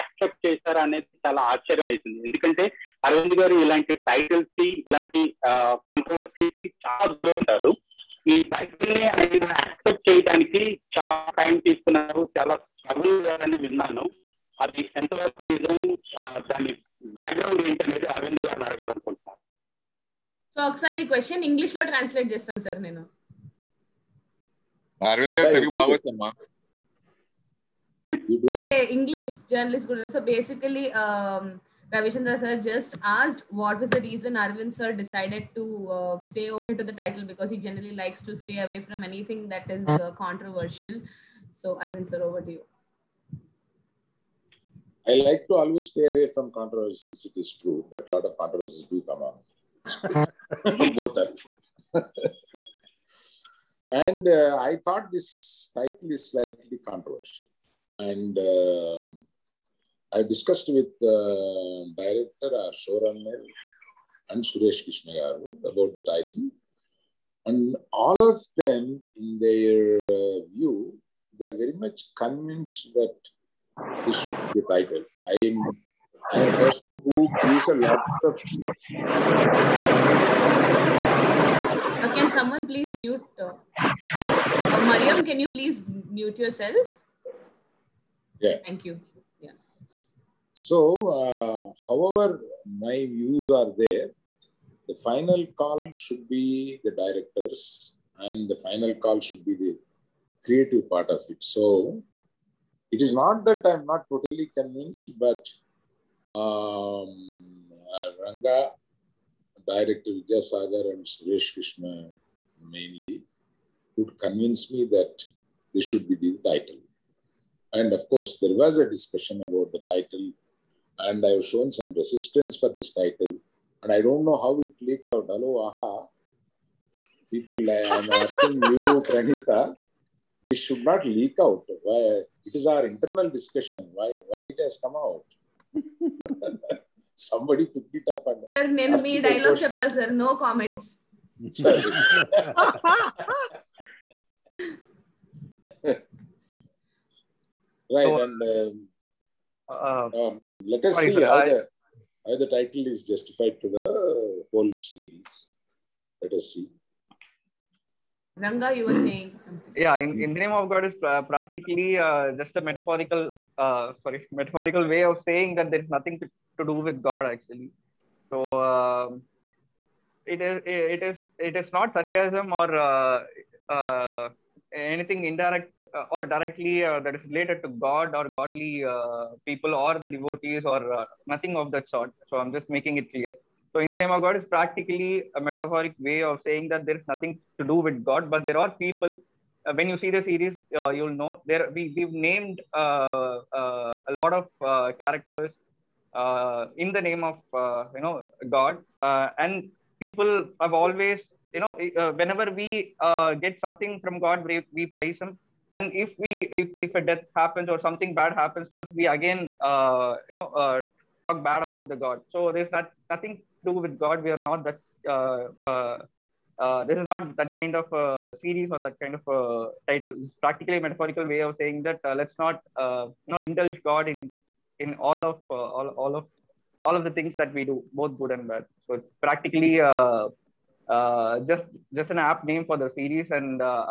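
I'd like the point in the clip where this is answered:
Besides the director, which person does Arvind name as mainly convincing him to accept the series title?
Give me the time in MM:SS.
01:51.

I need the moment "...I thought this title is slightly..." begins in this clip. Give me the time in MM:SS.
00:54.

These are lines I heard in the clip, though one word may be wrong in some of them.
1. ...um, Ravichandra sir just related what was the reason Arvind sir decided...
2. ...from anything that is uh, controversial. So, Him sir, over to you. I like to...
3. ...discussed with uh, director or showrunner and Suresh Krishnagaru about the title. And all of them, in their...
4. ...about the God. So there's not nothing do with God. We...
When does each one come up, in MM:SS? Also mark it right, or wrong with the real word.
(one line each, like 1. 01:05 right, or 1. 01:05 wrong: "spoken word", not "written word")
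1. 00:31 wrong: "asked", not "related"
2. 00:38 wrong: "Arvind", not "Him"
3. 01:00 right
4. 03:31 right.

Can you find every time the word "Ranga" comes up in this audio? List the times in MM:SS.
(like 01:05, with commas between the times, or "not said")
01:48, 02:38.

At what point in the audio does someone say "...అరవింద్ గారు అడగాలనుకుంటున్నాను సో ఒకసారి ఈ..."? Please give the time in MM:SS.
00:18.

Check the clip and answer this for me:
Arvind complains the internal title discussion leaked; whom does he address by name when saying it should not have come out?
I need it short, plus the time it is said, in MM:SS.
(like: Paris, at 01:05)
Pranita, at 02:09.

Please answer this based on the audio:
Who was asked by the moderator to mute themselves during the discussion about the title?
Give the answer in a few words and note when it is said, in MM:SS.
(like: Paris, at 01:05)
Mariam, at 01:24.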